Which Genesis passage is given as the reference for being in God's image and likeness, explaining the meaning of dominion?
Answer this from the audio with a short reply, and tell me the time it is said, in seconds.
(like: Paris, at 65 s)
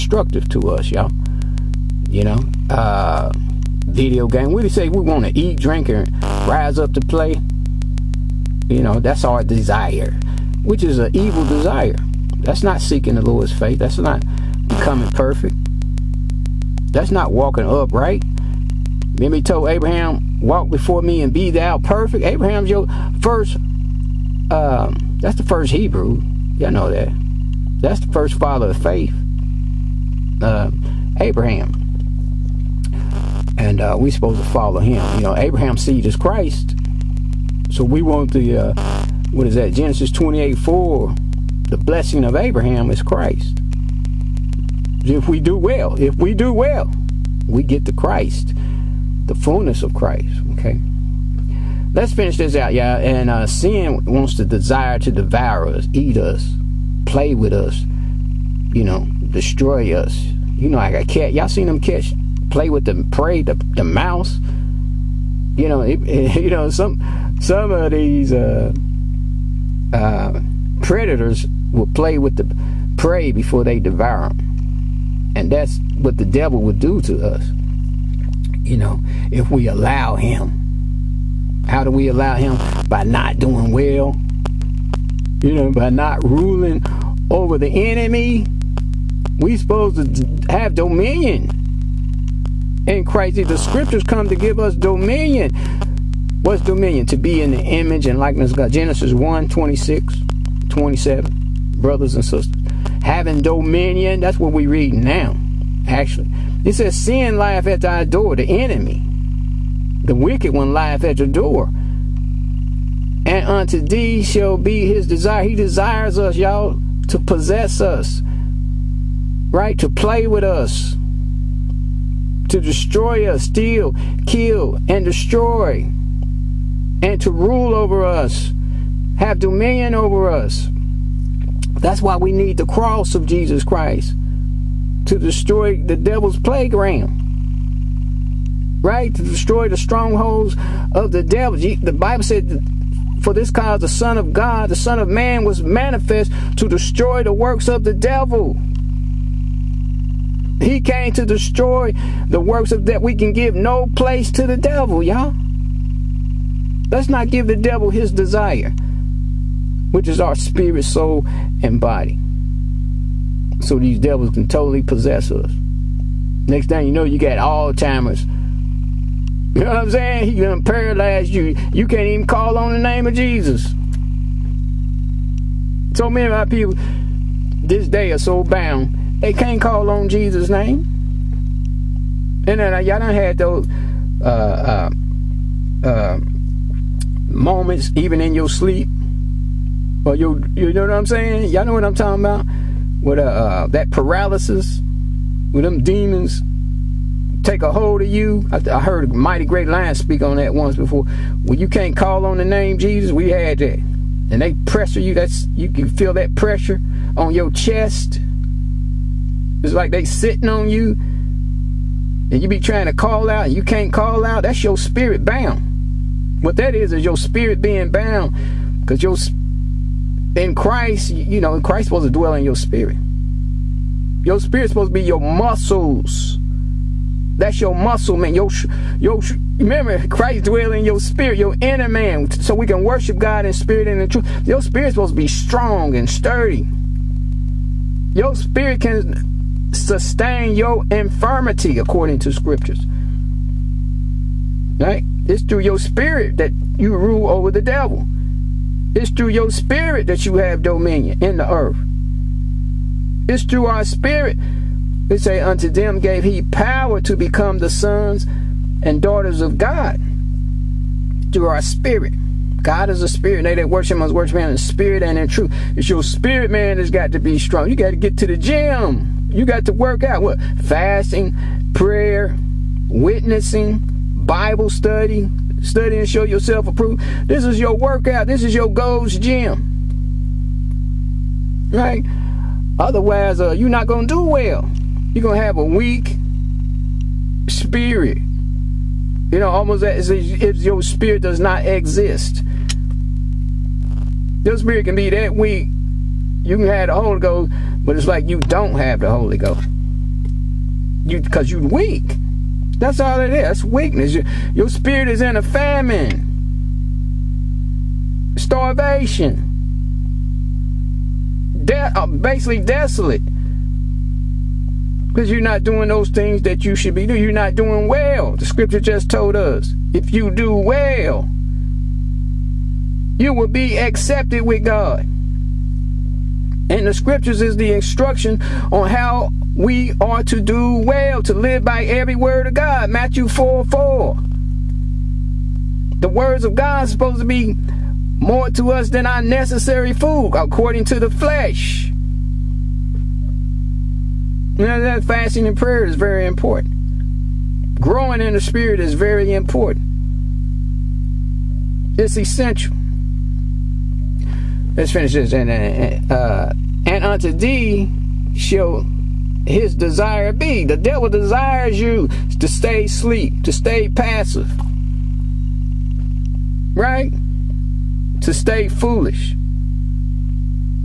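Genesis 1:26-27, at 98 s.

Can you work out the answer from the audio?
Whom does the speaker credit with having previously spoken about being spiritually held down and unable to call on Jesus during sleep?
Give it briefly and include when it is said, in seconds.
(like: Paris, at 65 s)
Mighty Great Lion, at 199 s.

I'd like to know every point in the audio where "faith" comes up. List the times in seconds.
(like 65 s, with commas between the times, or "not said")
13 s, 28 s.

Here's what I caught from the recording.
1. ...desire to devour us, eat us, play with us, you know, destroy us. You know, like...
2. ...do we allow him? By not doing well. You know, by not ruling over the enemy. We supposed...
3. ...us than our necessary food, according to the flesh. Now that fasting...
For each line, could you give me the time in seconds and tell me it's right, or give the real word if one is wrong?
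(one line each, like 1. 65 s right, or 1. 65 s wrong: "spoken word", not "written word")
1. 54 s right
2. 81 s right
3. 338 s right.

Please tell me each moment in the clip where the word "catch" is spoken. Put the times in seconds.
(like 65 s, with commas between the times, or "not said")
61 s.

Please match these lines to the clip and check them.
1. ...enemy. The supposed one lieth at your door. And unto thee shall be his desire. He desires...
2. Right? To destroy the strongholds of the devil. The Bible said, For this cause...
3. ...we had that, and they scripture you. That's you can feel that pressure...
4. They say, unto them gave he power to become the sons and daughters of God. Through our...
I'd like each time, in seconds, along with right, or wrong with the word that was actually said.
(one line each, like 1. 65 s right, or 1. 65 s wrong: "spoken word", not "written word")
1. 108 s wrong: "wicked", not "supposed"
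2. 138 s right
3. 203 s wrong: "pressure", not "scripture"
4. 255 s right.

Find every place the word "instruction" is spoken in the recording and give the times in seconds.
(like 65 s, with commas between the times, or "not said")
327 s.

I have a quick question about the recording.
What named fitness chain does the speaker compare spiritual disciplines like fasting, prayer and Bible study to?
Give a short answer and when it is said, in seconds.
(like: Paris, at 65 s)
Gold's Gym, at 278 s.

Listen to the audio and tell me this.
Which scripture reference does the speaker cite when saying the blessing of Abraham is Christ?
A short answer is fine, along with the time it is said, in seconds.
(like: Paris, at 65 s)
Genesis 28:4, at 39 s.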